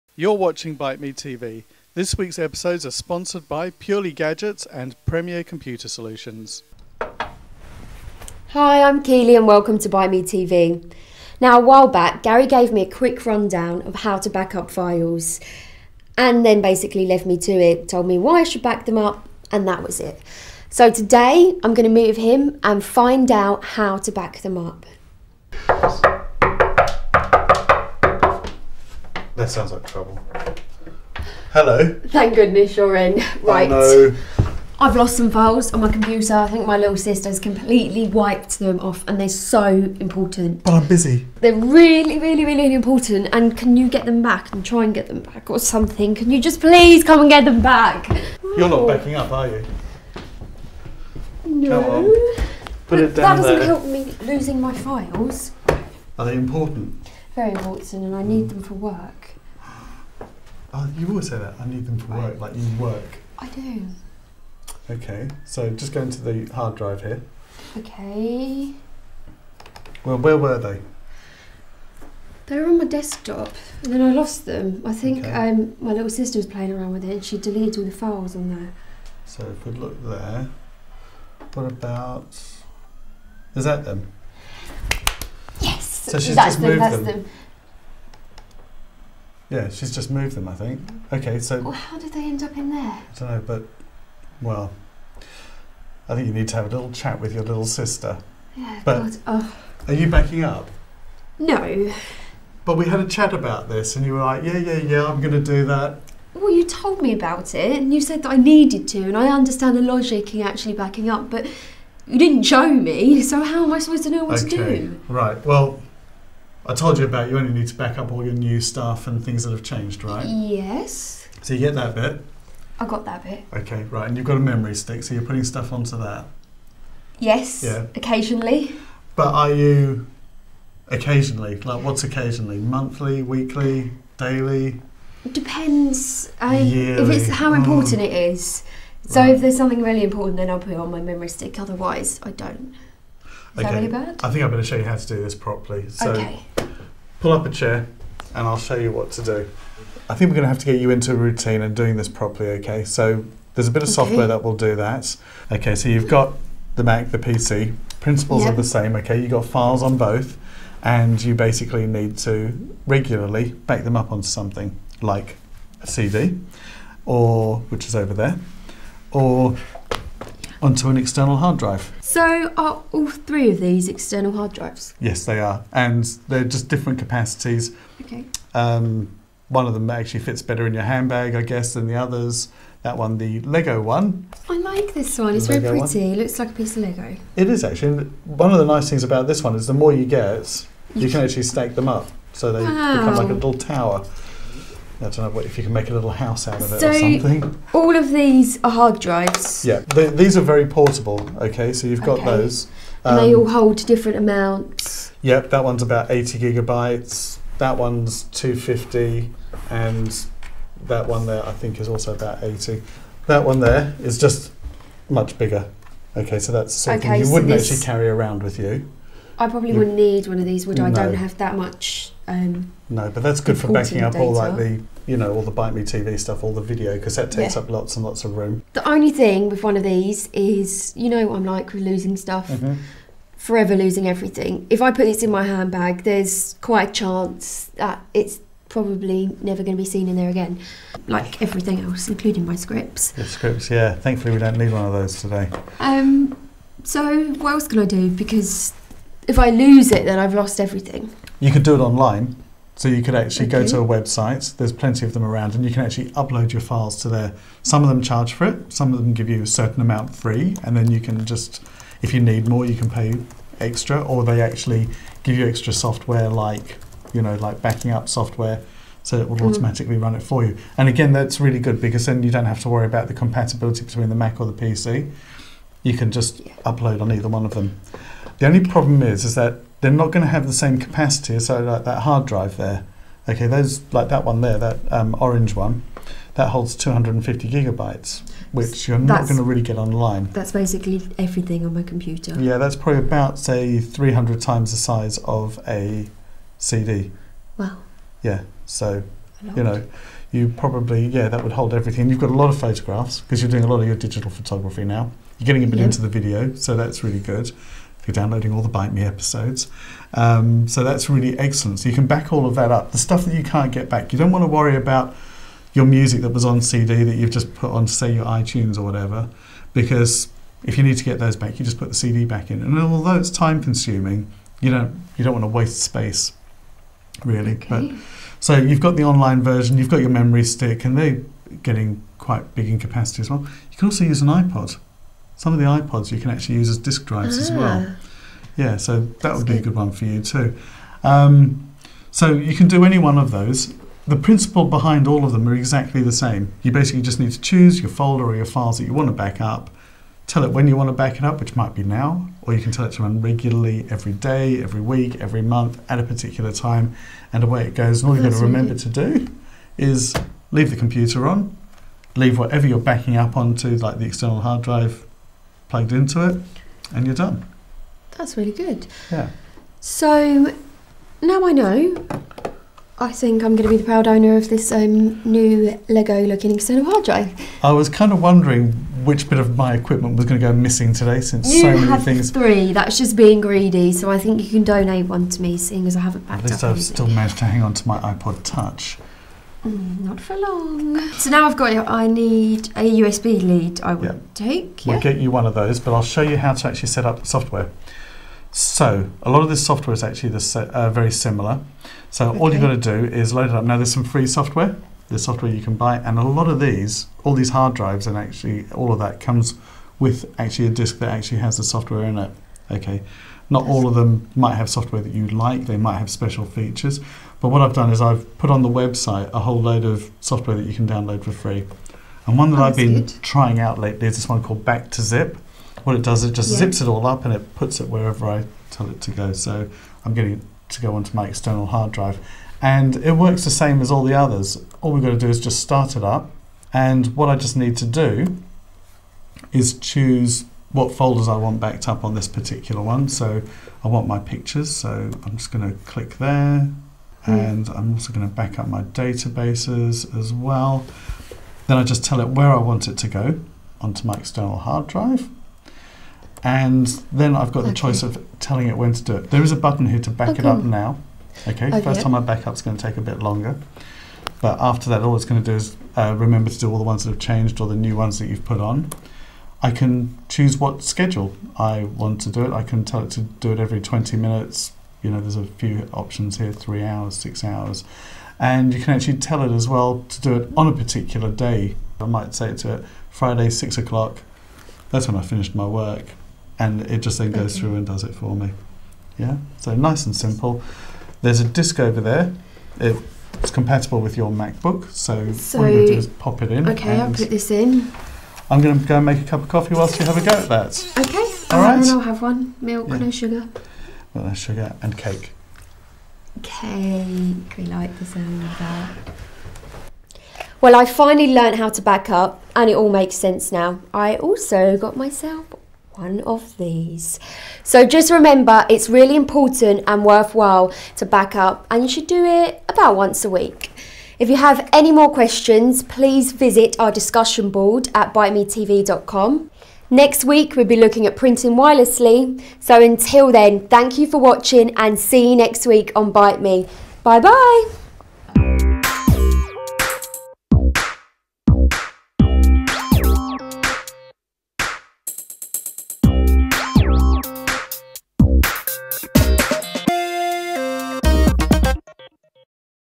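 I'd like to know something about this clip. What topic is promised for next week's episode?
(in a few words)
Printing wirelessly.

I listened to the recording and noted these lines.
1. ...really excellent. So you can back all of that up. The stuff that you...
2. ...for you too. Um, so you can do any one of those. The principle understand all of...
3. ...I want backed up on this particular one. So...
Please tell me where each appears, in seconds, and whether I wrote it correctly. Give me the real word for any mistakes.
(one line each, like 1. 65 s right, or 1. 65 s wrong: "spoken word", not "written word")
1. 311 s right
2. 339 s wrong: "behind", not "understand"
3. 441 s right.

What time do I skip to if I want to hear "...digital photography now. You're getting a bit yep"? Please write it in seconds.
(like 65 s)
303 s.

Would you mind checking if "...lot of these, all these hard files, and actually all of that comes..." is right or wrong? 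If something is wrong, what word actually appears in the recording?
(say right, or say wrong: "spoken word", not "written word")
wrong: "drives", not "files".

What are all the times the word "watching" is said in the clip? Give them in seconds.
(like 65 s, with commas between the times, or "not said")
0 s, 534 s.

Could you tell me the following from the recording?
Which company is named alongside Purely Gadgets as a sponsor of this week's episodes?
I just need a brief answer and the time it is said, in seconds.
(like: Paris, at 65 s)
Premier Computer Solutions, at 5 s.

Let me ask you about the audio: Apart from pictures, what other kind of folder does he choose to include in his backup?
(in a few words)
Databases.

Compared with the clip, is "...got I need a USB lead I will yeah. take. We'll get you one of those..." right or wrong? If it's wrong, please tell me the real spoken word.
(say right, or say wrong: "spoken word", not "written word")
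right.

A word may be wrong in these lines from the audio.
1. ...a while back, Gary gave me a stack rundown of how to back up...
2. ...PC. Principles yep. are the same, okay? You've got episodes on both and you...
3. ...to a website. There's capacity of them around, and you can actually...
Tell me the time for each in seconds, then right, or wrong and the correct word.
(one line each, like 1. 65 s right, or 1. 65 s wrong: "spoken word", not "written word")
1. 11 s wrong: "quick", not "stack"
2. 157 s wrong: "files", not "episodes"
3. 253 s wrong: "plenty", not "capacity".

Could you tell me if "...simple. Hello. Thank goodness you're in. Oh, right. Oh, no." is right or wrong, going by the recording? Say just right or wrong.
wrong.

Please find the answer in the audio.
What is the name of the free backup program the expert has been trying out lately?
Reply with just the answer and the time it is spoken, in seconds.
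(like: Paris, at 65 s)
Back to Zip, at 424 s.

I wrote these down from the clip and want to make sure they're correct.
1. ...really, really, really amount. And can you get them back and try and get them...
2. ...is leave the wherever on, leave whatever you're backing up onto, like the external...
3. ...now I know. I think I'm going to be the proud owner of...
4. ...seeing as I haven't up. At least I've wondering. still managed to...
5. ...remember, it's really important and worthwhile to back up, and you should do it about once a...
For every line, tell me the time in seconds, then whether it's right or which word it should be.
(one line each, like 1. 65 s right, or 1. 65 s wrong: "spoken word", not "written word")
1. 41 s wrong: "important", not "amount"
2. 359 s wrong: "computer", not "wherever"
3. 371 s right
4. 385 s wrong: "anything", not "wondering"
5. 518 s right.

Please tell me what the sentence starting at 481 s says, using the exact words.
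I might say to it, Friday, six o'clock, that's when I finished my work.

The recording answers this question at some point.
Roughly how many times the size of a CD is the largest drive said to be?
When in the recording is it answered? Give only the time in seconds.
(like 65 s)
293 s.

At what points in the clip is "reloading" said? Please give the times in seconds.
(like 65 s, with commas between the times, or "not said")
not said.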